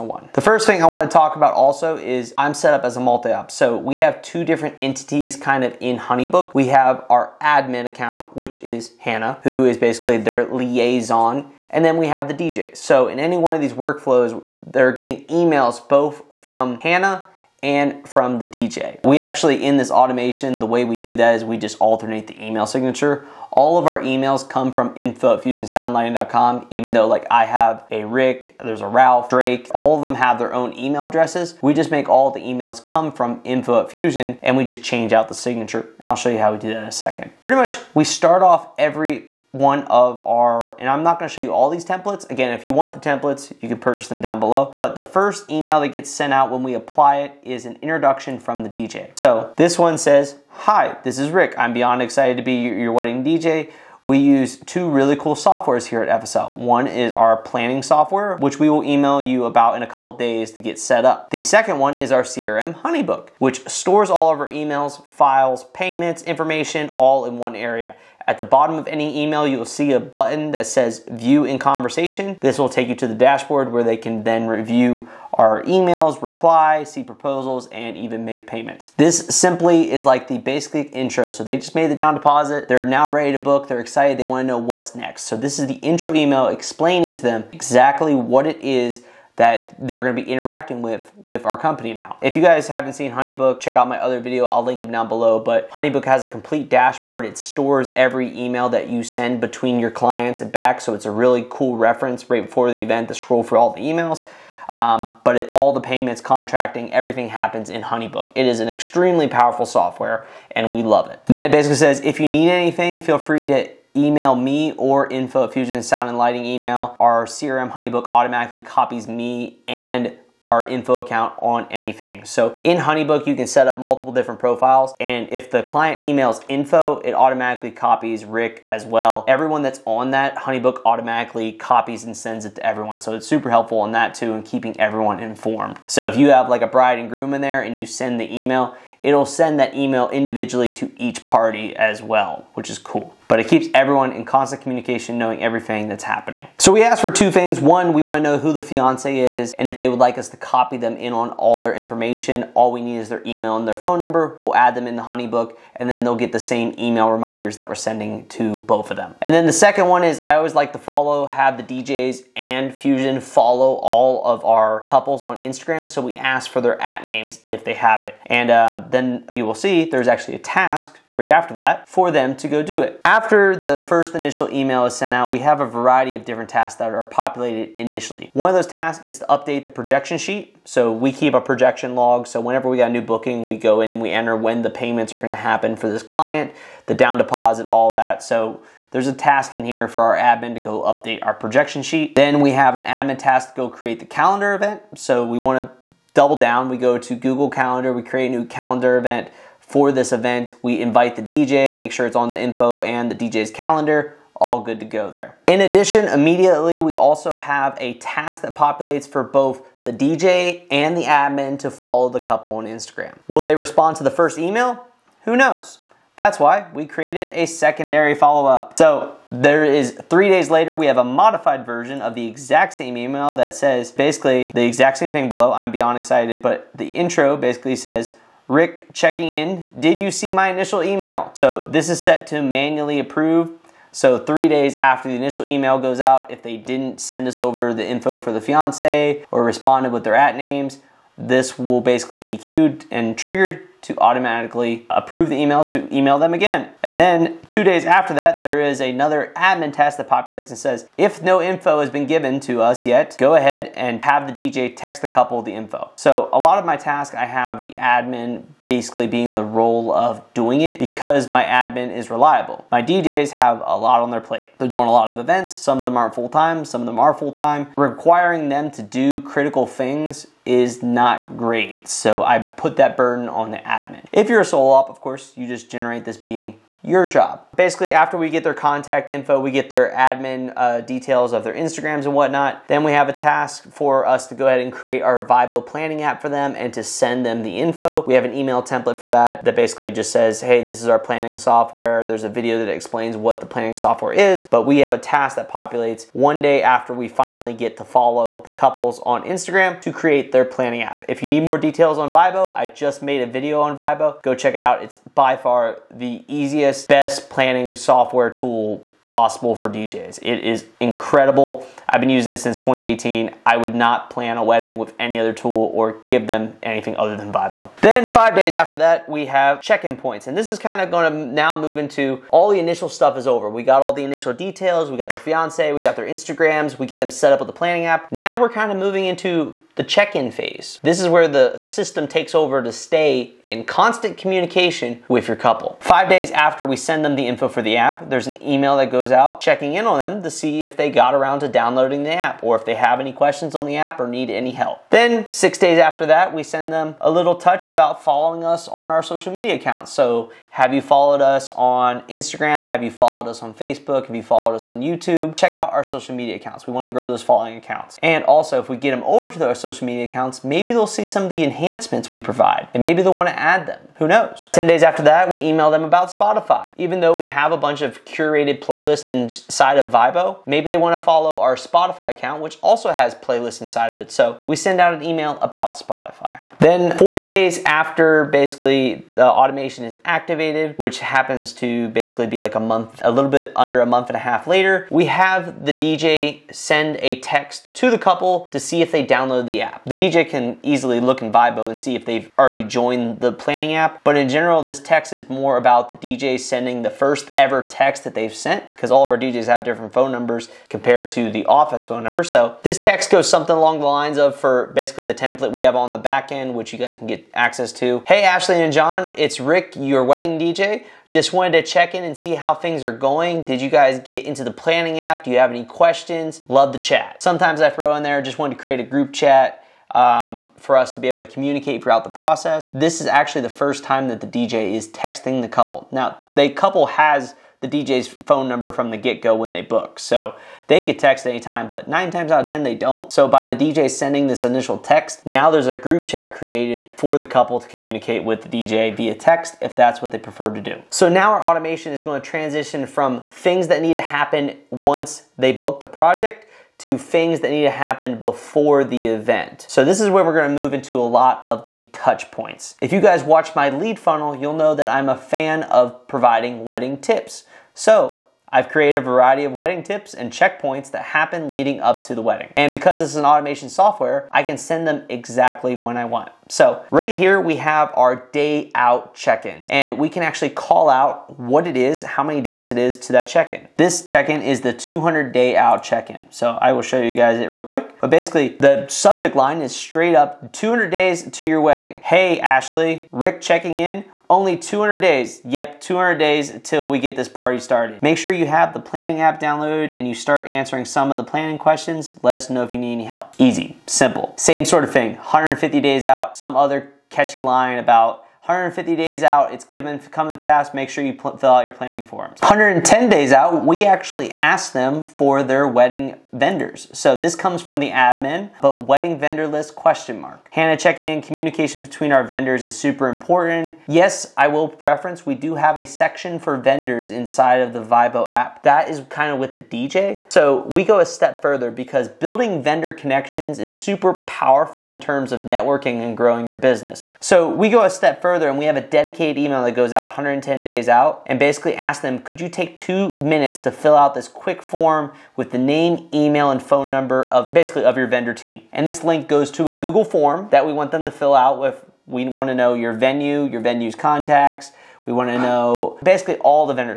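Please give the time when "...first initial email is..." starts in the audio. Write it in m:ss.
2:53.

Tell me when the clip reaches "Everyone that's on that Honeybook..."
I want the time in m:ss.
2:09.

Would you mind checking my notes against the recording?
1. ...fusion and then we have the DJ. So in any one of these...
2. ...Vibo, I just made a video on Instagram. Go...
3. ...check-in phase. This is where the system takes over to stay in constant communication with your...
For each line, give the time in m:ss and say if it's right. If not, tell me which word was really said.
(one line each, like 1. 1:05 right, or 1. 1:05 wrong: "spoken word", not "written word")
1. 0:10 wrong: "liaison", not "fusion"
2. 5:02 wrong: "Vibo", not "Instagram"
3. 5:29 right.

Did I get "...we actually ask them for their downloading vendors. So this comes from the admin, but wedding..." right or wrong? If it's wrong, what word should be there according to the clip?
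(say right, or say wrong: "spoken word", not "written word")
wrong: "wedding", not "downloading".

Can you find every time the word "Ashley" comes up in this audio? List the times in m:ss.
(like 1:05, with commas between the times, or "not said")
6:48, 8:02.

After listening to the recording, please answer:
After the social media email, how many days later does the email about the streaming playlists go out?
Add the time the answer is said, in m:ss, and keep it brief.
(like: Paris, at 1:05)
10, at 6:04.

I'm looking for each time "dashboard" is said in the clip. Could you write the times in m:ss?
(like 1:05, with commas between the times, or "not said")
1:13, 1:36.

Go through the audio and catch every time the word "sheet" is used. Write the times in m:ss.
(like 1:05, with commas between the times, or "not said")
3:00, 3:11.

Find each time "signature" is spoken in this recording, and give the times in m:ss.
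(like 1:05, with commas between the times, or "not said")
0:22, 0:35.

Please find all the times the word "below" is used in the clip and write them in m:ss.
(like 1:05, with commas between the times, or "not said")
0:44, 1:35, 3:45.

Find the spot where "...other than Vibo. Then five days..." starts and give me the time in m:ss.
5:16.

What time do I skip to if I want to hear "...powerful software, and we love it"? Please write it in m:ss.
1:49.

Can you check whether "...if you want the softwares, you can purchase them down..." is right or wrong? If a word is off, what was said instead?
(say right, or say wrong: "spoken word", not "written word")
wrong: "templates", not "softwares".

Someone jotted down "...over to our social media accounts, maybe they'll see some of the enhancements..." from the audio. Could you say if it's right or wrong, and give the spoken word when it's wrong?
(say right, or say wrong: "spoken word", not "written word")
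right.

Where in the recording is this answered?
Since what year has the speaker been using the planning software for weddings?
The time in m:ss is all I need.
5:12.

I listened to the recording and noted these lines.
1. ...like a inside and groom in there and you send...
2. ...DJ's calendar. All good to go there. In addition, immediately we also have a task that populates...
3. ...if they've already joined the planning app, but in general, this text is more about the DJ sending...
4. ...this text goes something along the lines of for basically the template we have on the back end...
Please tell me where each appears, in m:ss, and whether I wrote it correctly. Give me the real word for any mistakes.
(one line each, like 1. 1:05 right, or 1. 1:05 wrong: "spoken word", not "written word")
1. 2:16 wrong: "bride", not "inside"
2. 3:23 right
3. 6:31 right
4. 6:42 right.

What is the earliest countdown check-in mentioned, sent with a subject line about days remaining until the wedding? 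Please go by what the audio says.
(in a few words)
200 days.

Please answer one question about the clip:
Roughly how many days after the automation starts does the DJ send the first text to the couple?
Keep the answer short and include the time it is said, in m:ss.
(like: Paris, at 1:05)
40, at 6:16.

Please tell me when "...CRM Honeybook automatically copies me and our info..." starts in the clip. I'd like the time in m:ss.
1:57.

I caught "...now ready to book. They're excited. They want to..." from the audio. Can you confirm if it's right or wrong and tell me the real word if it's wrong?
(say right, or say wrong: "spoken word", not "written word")
right.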